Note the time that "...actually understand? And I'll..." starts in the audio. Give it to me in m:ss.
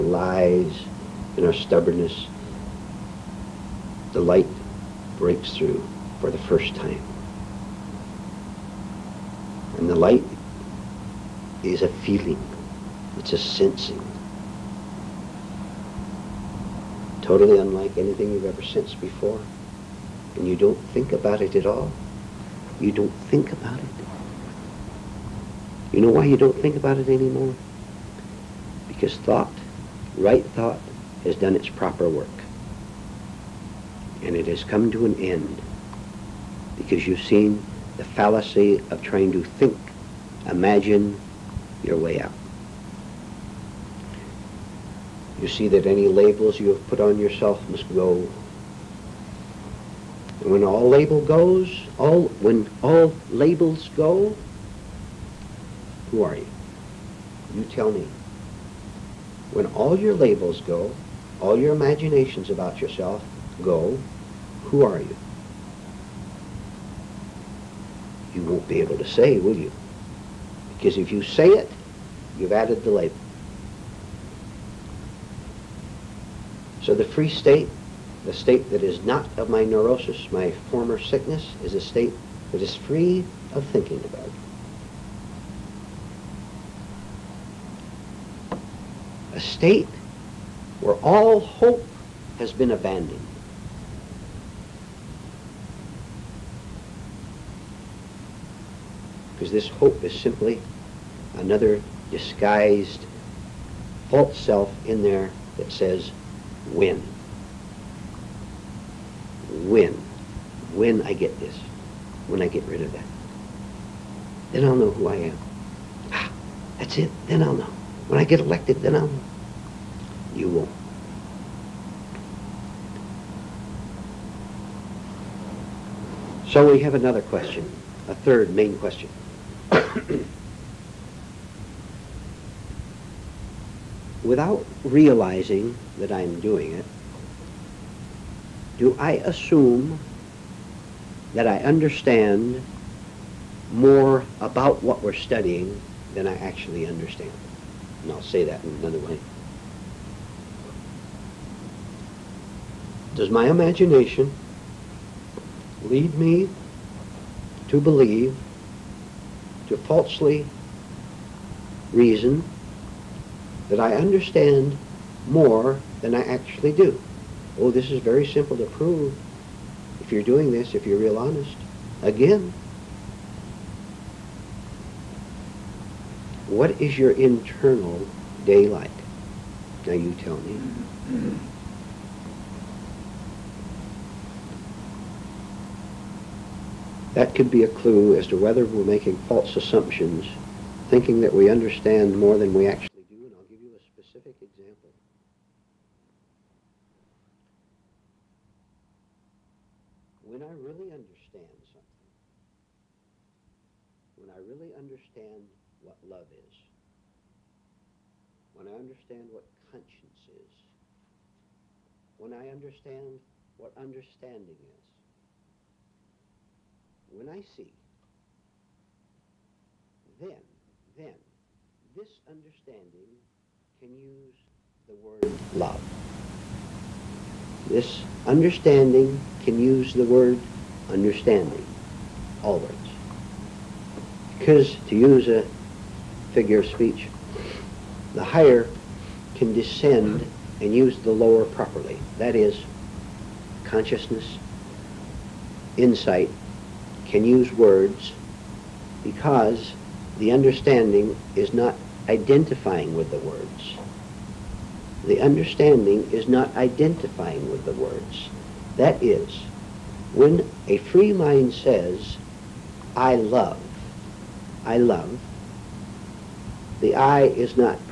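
2:26.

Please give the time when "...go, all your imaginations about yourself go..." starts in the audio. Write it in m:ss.
1:00.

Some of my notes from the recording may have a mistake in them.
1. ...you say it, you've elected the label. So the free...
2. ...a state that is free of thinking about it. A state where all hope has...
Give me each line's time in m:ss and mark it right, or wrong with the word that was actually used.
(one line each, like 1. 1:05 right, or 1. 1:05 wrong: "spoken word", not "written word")
1. 1:11 wrong: "added", not "elected"
2. 1:21 right.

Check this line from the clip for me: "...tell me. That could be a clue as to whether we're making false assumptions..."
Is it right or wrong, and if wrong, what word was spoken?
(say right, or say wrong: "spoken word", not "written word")
right.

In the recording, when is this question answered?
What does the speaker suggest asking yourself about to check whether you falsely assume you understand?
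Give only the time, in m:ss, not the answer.
2:57.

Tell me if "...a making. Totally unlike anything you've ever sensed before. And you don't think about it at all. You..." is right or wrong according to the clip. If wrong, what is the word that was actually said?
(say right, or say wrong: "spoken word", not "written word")
wrong: "sensing", not "making".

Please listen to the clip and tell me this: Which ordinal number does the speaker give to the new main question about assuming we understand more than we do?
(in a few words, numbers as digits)
third.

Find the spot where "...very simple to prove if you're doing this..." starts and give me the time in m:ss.
2:47.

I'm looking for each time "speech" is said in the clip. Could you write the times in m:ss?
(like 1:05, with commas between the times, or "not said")
3:56.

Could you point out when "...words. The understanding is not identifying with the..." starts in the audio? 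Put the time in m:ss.
4:13.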